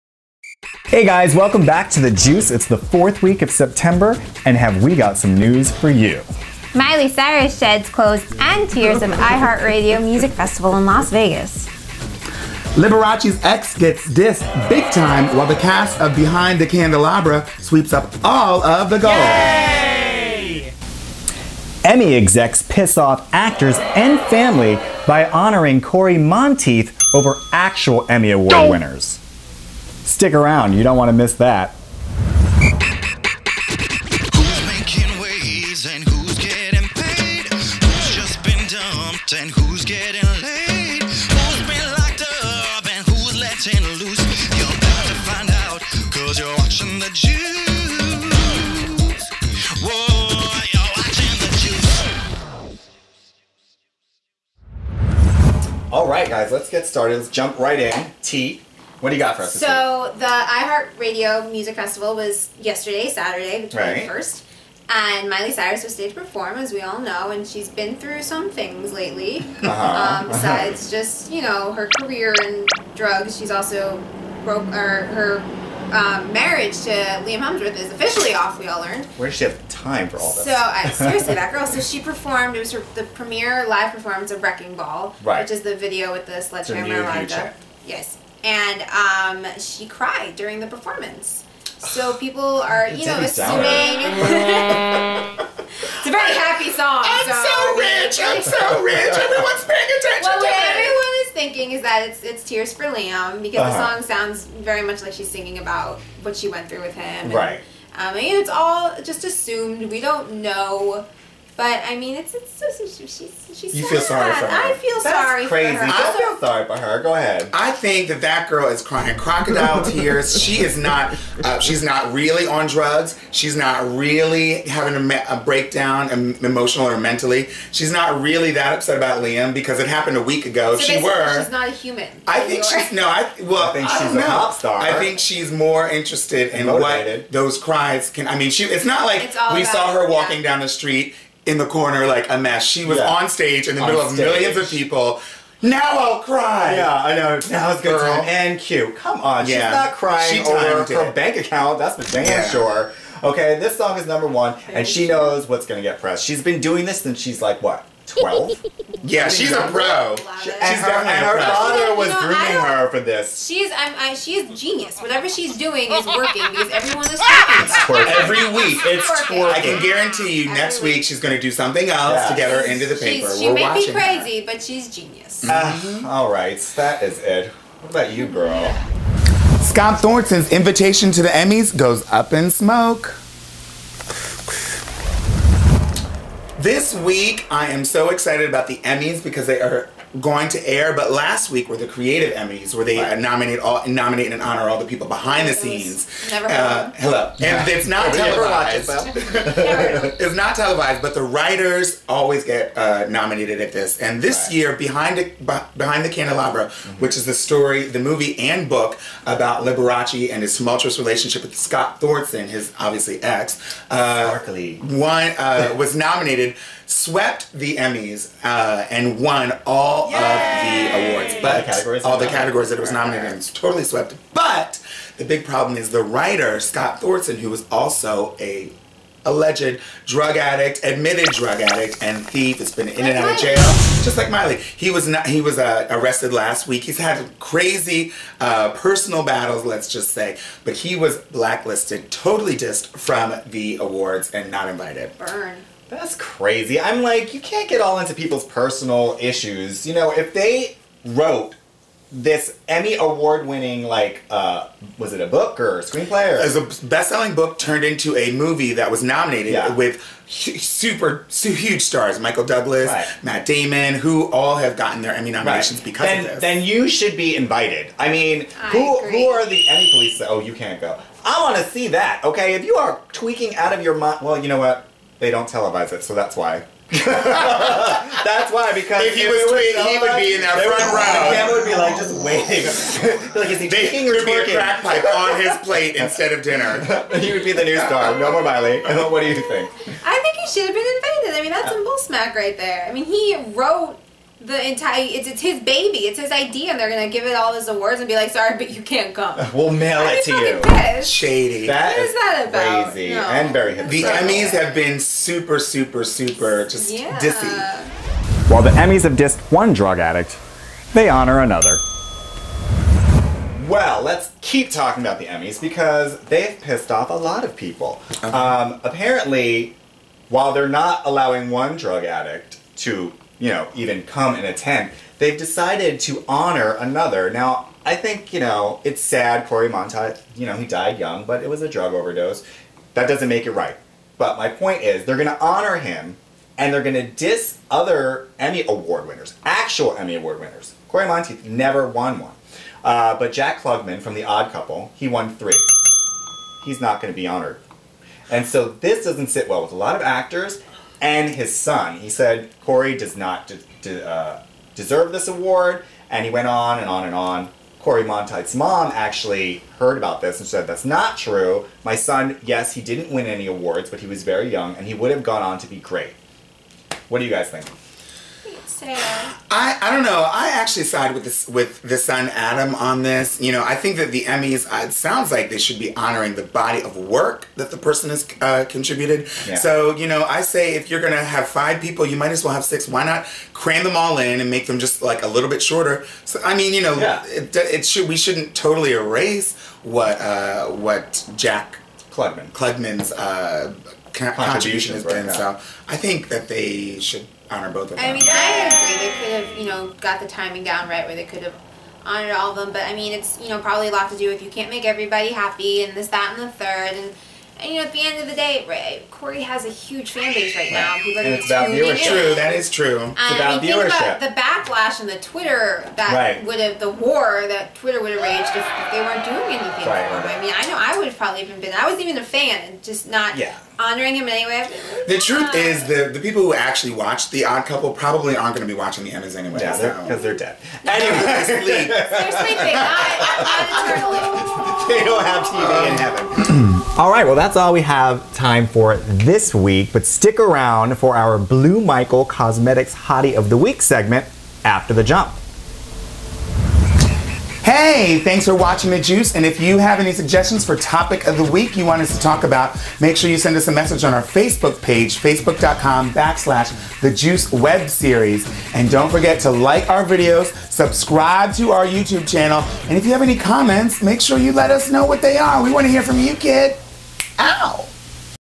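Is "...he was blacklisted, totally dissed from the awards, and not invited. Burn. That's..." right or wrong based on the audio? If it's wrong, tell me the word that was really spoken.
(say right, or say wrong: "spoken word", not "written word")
right.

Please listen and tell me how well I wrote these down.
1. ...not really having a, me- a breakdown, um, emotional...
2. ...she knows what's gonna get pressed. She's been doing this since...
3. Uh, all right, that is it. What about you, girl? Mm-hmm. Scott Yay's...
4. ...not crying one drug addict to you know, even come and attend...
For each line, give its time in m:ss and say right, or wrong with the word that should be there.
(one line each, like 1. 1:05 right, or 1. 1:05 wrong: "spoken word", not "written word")
1. 2:03 right
2. 2:34 right
3. 2:55 wrong: "Thorson", not "Yay"
4. 5:20 wrong: "allowing", not "crying".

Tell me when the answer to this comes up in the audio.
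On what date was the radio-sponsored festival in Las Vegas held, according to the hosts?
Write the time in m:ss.
1:03.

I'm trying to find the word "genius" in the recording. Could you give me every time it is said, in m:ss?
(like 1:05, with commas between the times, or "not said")
2:44, 2:54.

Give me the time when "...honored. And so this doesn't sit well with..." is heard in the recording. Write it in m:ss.
5:47.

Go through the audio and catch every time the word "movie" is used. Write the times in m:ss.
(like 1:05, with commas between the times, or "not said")
3:27, 4:18.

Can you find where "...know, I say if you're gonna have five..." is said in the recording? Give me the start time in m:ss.
6:20.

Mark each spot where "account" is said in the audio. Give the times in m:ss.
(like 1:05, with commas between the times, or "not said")
2:31.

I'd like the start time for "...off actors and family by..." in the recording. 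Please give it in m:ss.
0:22.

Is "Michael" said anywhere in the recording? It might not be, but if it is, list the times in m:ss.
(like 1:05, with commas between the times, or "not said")
4:22, 7:21.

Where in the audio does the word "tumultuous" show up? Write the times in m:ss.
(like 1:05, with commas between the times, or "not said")
3:30.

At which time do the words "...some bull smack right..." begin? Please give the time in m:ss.
4:51.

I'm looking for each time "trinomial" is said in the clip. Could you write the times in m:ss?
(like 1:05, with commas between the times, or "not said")
not said.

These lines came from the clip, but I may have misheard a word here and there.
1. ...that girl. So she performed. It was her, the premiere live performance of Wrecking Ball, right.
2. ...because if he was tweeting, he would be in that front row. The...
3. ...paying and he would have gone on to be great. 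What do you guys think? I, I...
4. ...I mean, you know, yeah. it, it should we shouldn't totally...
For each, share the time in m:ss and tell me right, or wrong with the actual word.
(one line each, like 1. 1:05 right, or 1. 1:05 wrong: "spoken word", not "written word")
1. 1:21 right
2. 4:38 right
3. 6:04 wrong: "young", not "paying"
4. 6:26 right.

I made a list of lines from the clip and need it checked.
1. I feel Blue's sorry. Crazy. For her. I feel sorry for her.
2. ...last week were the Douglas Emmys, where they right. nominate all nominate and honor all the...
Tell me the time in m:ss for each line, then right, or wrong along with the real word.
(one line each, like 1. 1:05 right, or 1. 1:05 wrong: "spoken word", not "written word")
1. 1:54 wrong: "That", not "Blue"
2. 3:11 wrong: "Creative", not "Douglas".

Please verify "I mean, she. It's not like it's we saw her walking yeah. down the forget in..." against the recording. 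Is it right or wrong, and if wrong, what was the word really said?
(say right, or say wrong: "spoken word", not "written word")
wrong: "street", not "forget".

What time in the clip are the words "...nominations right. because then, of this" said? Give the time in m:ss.
4:25.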